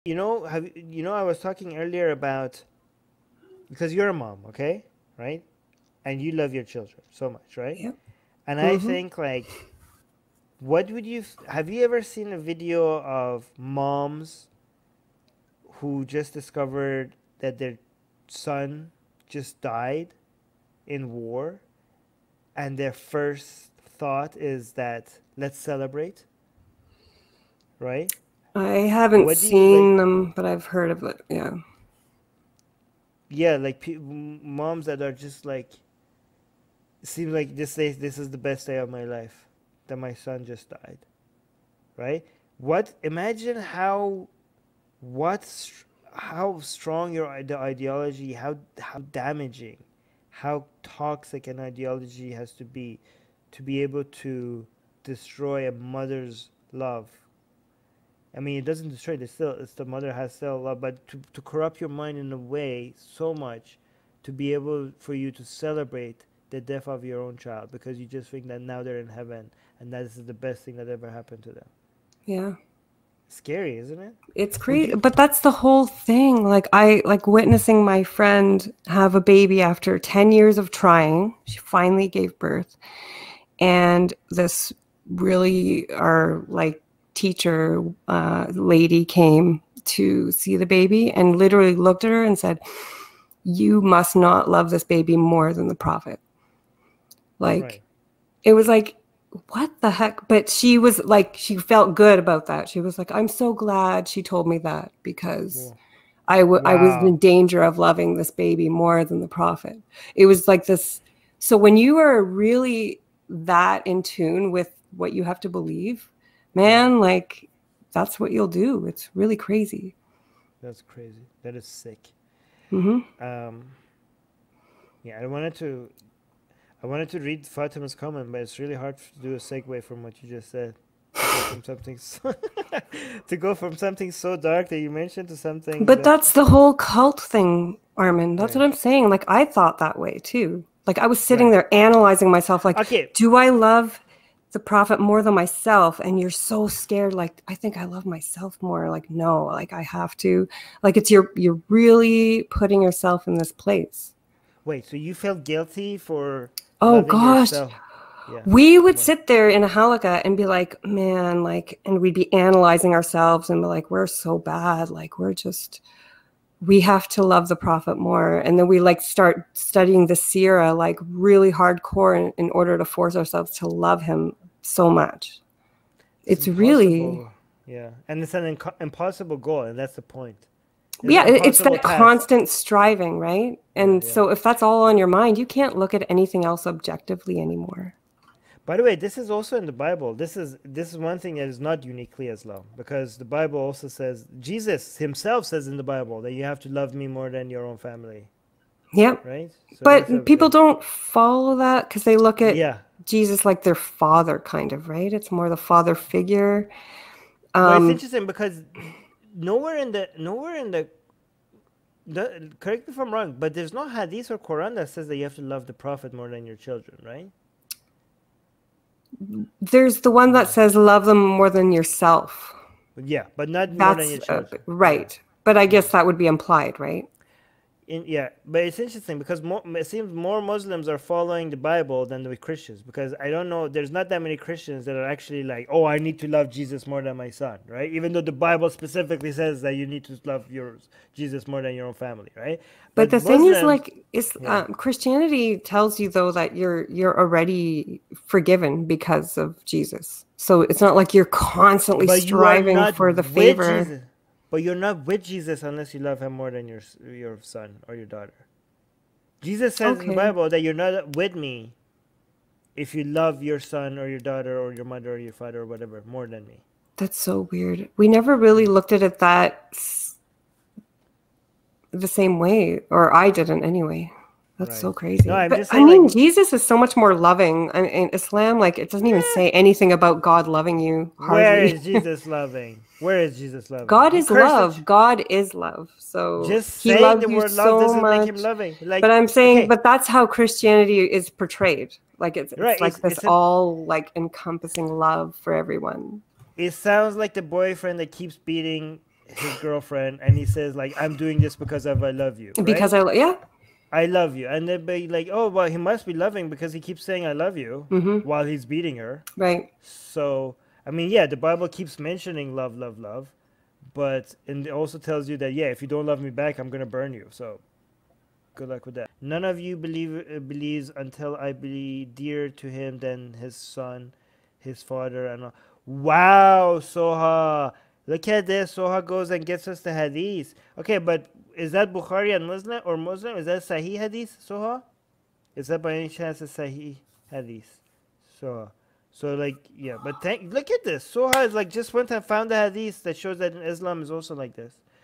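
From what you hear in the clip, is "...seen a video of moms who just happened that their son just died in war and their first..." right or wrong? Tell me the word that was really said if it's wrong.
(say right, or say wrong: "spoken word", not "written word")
wrong: "discovered", not "happened".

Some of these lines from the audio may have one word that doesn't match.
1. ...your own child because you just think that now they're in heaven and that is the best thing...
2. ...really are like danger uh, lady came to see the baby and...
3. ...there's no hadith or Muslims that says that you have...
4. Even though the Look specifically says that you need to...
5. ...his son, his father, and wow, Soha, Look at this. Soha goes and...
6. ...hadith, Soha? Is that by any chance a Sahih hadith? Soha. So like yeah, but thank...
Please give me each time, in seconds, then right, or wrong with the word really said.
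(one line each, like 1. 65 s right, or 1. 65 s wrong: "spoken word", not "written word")
1. 67 s right
2. 85 s wrong: "teacher", not "danger"
3. 213 s wrong: "Quran", not "Muslims"
4. 237 s wrong: "Bible", not "Look"
5. 323 s right
6. 333 s right.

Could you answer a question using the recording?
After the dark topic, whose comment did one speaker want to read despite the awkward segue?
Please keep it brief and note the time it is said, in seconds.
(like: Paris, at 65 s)
Fatima, at 127 s.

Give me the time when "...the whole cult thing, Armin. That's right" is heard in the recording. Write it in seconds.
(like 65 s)
136 s.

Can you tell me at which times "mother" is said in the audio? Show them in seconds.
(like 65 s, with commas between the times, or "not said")
55 s, 59 s, 264 s.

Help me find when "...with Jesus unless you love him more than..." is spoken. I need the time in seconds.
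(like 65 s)
255 s.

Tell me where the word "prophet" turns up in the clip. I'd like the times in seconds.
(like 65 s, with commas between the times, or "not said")
95 s, 109 s, 144 s, 167 s, 215 s.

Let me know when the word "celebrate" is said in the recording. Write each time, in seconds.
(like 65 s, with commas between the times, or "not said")
25 s, 65 s.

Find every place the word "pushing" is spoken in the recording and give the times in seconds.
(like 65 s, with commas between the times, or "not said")
not said.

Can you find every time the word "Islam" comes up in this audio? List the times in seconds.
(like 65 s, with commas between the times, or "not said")
192 s, 278 s, 343 s.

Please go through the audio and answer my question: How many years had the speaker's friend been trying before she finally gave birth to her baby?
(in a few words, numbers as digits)
10.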